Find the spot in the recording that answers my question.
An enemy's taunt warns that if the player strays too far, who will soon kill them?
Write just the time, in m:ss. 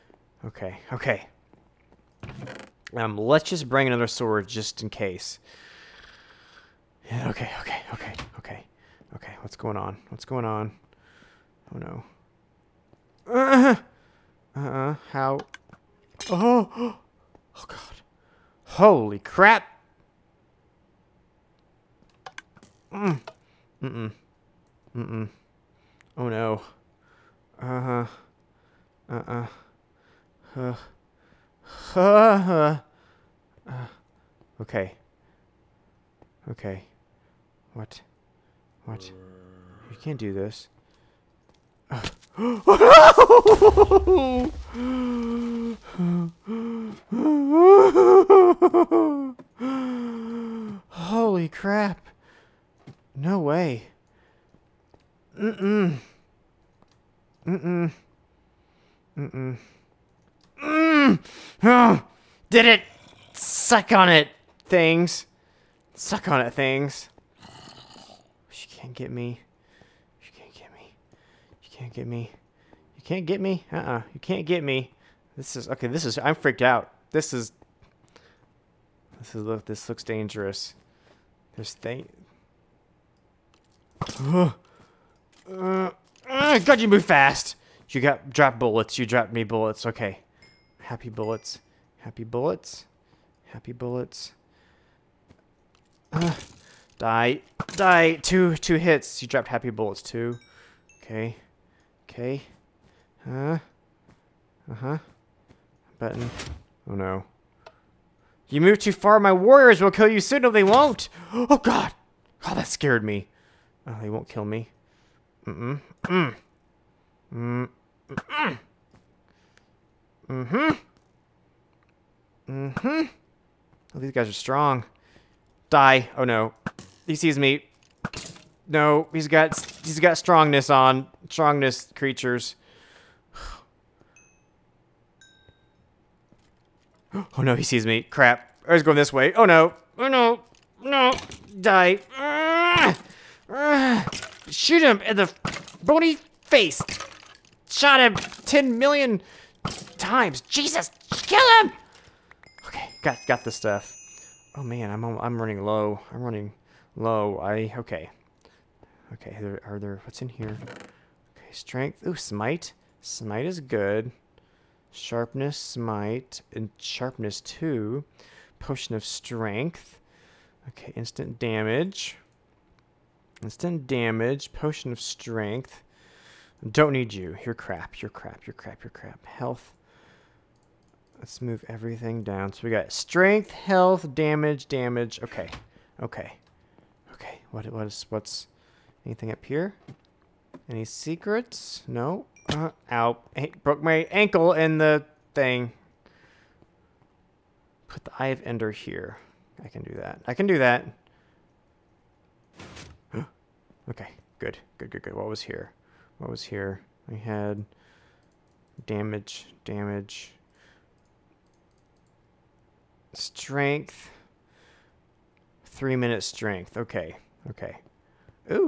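1:49.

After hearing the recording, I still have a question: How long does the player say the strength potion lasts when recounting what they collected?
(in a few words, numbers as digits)
3 minutes.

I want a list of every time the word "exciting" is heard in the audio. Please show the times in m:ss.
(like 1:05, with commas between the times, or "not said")
not said.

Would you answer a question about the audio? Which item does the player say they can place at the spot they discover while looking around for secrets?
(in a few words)
Eye of Ender.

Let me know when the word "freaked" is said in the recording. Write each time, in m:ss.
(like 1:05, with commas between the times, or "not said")
1:16.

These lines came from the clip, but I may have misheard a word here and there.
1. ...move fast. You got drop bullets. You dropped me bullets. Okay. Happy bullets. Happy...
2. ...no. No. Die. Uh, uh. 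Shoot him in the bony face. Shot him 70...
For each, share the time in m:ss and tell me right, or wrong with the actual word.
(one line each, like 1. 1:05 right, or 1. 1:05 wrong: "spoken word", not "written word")
1. 1:26 right
2. 2:20 wrong: "10", not "70".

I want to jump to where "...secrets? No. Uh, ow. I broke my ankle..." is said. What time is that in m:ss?
3:10.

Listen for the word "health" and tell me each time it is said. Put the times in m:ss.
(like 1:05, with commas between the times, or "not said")
2:59, 3:03.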